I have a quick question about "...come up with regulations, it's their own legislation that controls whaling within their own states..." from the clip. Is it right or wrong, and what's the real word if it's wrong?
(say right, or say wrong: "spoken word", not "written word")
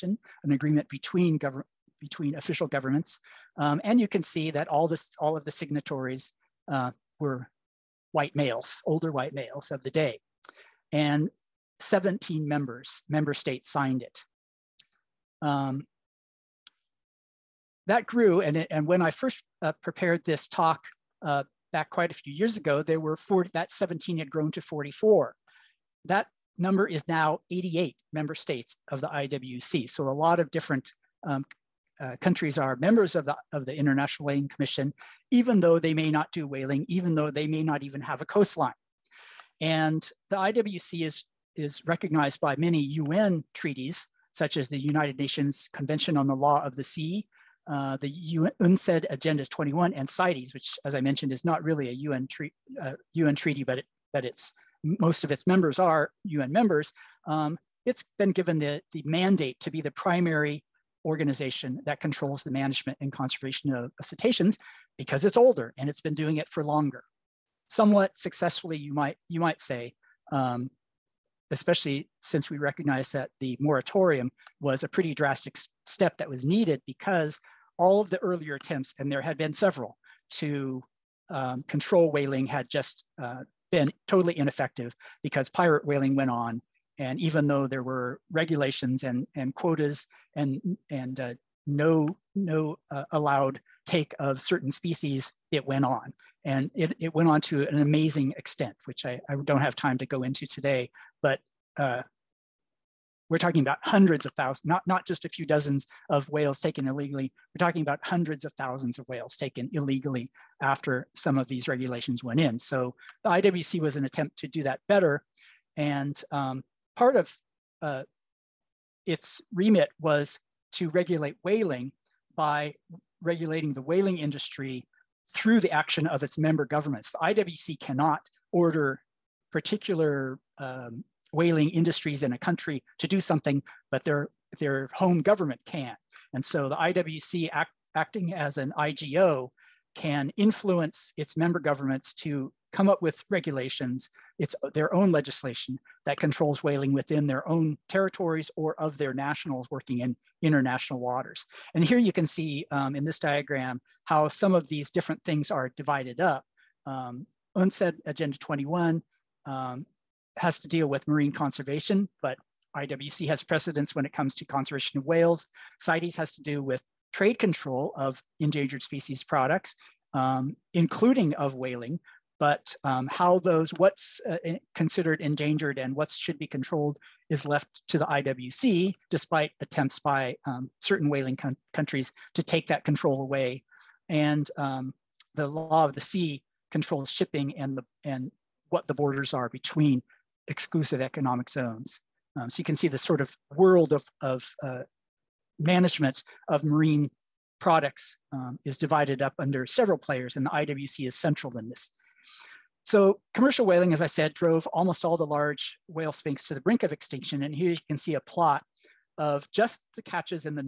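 wrong: "territories", not "states".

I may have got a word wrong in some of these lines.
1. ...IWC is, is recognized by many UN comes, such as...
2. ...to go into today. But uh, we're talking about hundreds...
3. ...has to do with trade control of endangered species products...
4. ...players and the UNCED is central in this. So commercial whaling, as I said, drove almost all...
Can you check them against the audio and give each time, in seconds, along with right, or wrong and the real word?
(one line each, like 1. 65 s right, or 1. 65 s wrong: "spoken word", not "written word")
1. 40 s wrong: "treaties", not "comes"
2. 99 s right
3. 166 s right
4. 199 s wrong: "IWC", not "UNCED".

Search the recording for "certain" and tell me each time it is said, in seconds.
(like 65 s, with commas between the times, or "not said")
94 s, 180 s.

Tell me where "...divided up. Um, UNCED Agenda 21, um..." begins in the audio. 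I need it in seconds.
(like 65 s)
155 s.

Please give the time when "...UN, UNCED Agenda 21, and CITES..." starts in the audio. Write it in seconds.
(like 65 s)
48 s.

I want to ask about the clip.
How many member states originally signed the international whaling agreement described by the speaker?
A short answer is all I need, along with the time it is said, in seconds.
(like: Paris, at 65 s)
17, at 11 s.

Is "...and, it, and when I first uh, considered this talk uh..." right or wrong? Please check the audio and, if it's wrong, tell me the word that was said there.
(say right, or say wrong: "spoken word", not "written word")
wrong: "prepared", not "considered".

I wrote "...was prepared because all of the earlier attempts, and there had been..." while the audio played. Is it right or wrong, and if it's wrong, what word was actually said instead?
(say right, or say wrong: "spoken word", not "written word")
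wrong: "needed", not "prepared".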